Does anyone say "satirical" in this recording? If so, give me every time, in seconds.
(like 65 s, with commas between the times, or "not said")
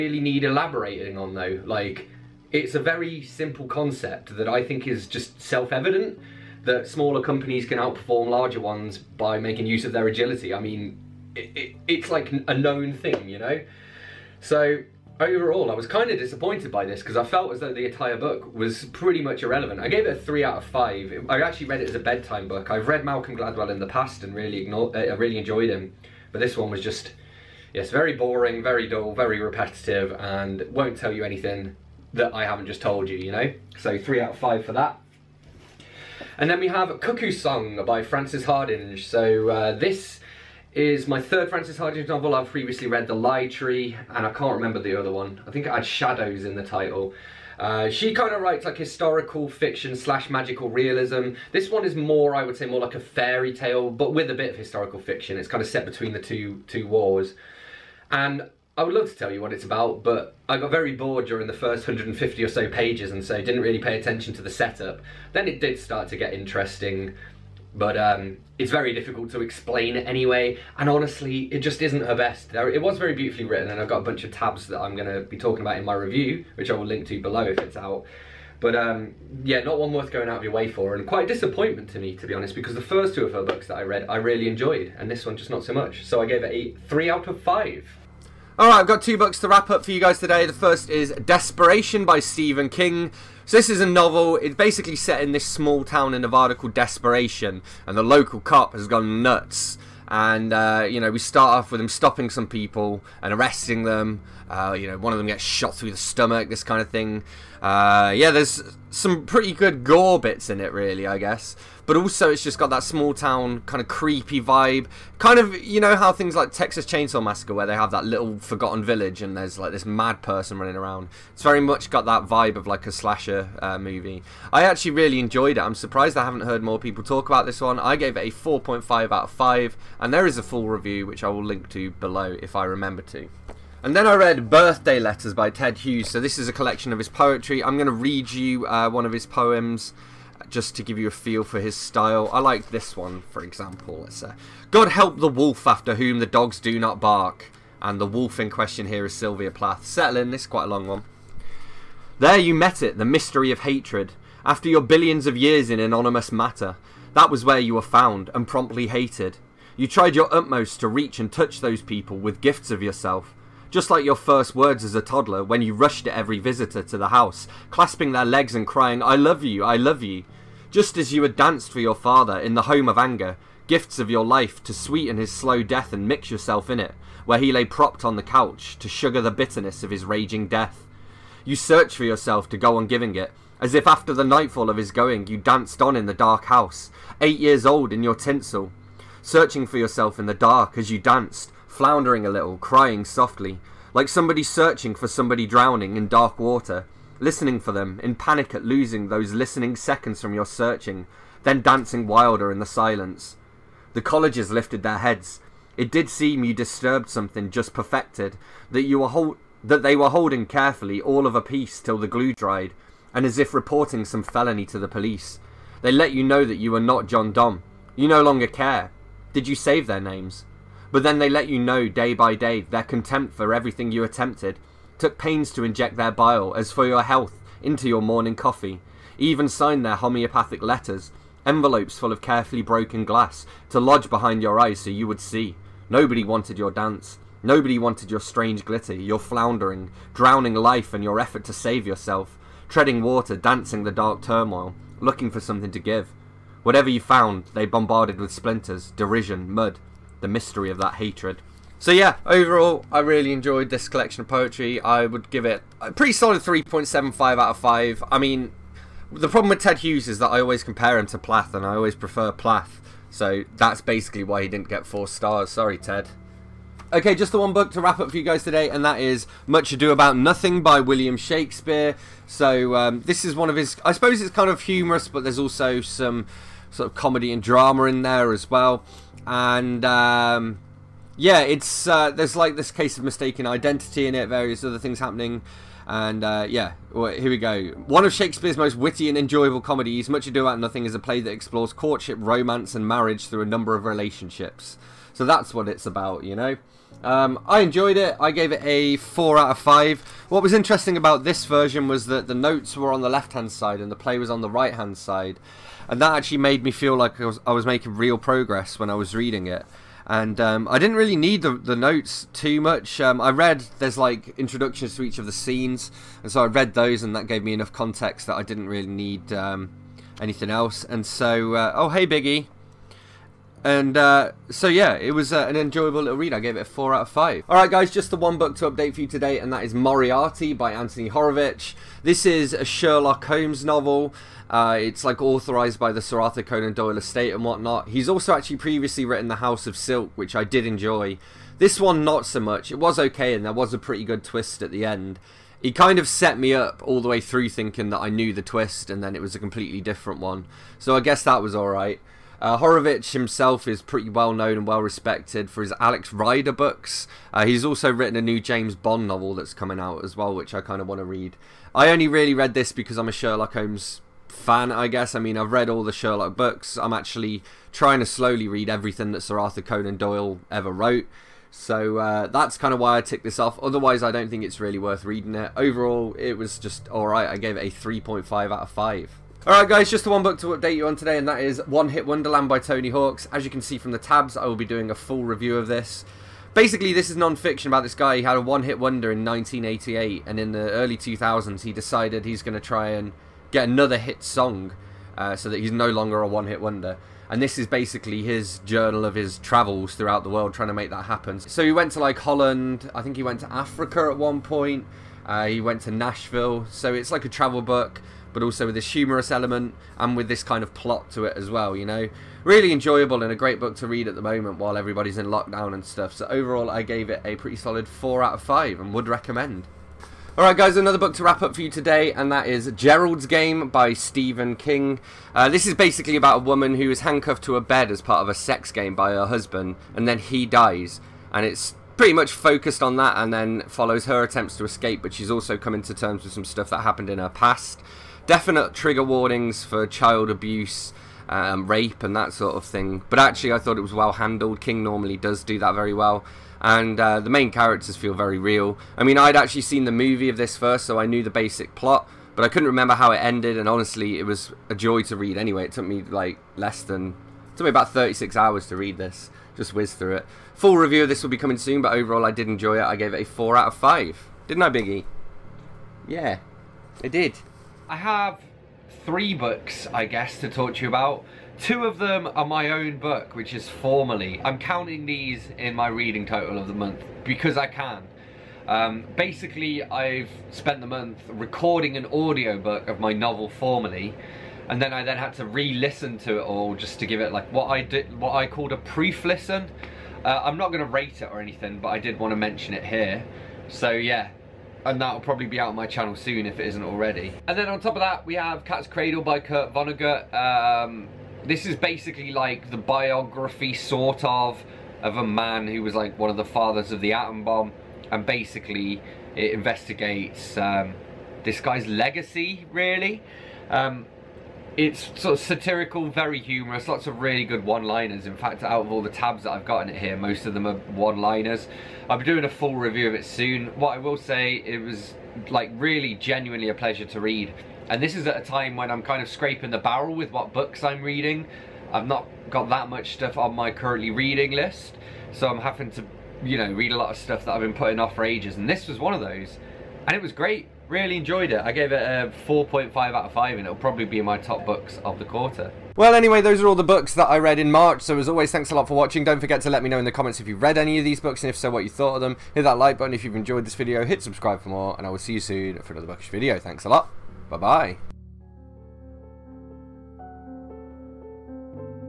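515 s.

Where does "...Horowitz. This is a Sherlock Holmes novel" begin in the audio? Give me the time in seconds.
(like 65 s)
331 s.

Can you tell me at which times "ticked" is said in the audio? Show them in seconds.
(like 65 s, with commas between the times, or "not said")
373 s.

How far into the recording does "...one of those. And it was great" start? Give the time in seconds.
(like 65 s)
538 s.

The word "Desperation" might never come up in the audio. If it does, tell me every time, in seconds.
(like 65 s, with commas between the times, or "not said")
91 s, 96 s.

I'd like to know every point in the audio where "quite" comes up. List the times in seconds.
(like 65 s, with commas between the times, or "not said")
81 s, 150 s.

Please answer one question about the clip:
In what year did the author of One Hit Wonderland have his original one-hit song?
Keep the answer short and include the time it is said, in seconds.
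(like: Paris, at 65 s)
1988, at 389 s.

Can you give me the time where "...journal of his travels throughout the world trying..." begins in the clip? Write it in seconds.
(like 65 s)
398 s.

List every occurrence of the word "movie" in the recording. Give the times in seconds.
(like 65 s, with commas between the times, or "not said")
123 s, 449 s.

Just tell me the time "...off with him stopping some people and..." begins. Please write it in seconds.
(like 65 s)
101 s.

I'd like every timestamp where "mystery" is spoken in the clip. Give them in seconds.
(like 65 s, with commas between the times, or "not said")
153 s, 250 s.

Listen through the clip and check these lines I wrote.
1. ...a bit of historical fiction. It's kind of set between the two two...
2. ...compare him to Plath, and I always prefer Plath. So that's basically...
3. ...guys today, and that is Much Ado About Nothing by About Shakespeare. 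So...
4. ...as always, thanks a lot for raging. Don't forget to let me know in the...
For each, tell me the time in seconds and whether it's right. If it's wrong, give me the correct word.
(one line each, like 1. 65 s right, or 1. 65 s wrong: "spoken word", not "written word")
1. 54 s right
2. 260 s right
3. 268 s wrong: "William", not "About"
4. 548 s wrong: "watching", not "raging".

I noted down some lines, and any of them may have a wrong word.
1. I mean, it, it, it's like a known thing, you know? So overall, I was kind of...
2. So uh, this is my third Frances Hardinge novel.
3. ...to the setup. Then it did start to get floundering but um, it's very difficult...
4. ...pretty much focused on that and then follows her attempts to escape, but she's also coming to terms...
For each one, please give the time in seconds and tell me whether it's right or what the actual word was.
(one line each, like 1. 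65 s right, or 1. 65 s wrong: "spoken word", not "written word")
1. 10 s right
2. 39 s right
3. 64 s wrong: "interesting", not "floundering"
4. 431 s right.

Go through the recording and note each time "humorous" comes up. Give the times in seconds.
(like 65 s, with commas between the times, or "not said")
274 s, 408 s, 516 s.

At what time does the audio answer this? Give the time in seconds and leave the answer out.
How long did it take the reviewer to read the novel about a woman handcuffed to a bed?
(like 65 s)
457 s.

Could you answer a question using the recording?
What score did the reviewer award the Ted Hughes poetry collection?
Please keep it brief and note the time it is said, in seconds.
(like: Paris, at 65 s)
3.75 out of 5, at 256 s.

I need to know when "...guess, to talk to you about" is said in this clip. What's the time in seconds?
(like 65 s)
470 s.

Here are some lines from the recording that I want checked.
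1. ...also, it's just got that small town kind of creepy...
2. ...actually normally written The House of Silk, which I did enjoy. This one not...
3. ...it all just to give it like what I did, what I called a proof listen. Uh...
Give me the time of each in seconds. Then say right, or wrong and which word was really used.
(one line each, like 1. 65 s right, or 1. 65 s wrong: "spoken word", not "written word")
1. 111 s right
2. 338 s wrong: "previously", not "normally"
3. 486 s right.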